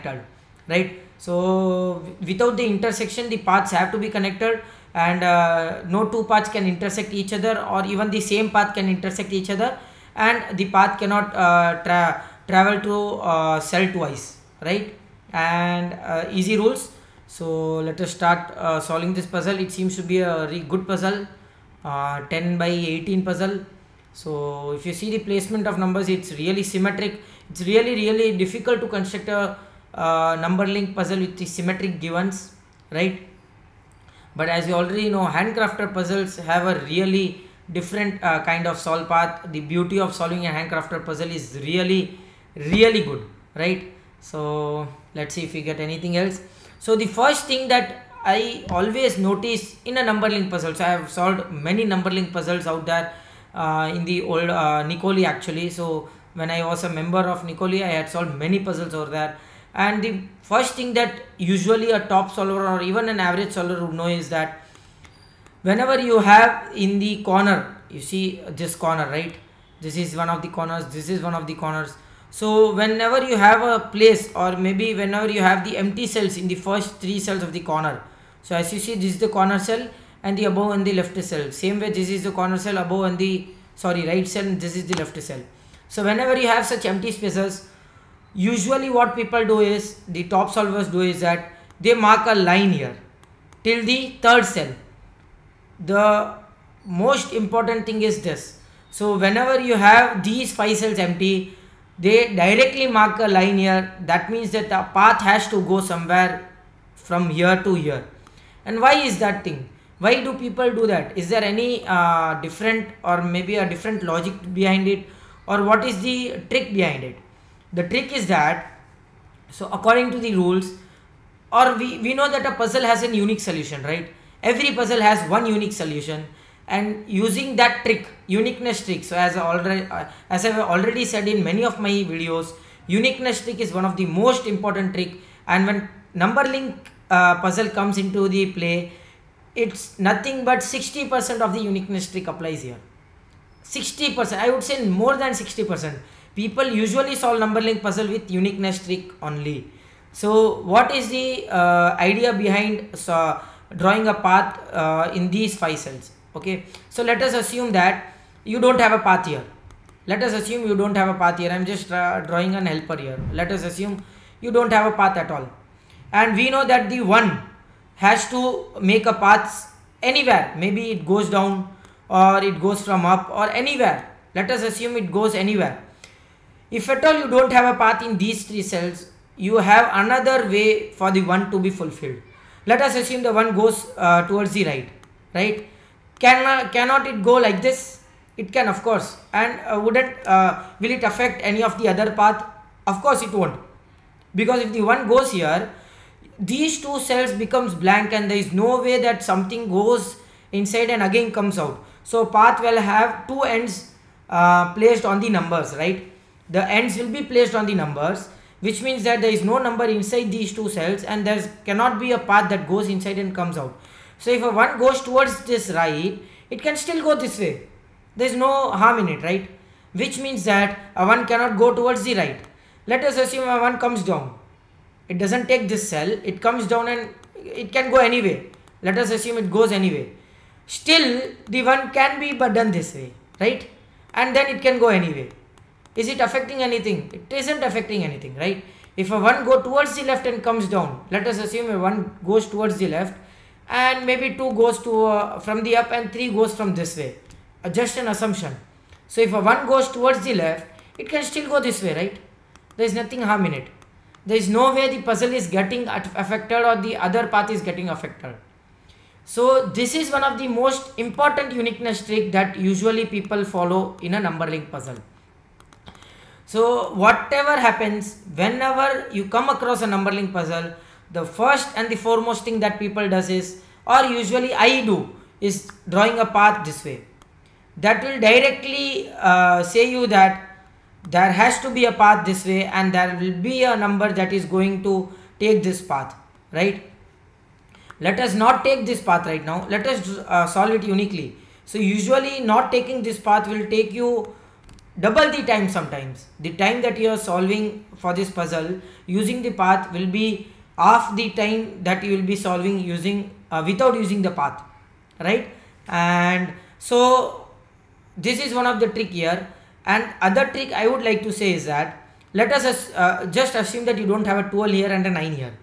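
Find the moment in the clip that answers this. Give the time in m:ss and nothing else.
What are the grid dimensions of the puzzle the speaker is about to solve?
0:22.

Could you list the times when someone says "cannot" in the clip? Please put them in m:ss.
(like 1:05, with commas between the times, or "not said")
0:11, 3:06, 3:31, 3:41.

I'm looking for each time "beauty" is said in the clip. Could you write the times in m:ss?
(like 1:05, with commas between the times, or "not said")
0:39.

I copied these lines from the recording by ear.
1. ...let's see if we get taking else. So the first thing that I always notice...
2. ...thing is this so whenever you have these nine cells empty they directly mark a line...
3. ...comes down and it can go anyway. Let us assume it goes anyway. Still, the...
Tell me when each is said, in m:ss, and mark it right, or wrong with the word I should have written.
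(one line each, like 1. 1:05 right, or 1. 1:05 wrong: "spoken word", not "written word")
1. 0:45 wrong: "anything", not "taking"
2. 1:37 wrong: "five", not "nine"
3. 3:46 right.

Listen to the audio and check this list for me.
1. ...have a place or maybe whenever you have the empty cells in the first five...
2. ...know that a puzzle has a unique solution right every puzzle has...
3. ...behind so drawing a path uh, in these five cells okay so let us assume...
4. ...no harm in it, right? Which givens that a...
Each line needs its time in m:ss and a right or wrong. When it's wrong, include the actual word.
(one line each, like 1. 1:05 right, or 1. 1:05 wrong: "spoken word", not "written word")
1. 1:13 wrong: "three", not "five"
2. 2:02 right
3. 2:32 right
4. 3:38 wrong: "means", not "givens".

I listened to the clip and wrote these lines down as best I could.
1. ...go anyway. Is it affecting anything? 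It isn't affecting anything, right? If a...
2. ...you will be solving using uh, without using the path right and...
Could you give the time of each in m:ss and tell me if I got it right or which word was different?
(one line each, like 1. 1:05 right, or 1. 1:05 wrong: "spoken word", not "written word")
1. 3:54 right
2. 5:02 right.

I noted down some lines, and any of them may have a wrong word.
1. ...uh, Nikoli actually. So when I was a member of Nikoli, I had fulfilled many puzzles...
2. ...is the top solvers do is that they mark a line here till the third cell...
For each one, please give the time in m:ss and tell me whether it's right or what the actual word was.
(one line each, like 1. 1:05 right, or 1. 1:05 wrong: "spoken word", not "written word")
1. 0:54 wrong: "solved", not "fulfilled"
2. 1:29 right.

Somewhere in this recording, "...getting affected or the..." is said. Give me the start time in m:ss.
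4:15.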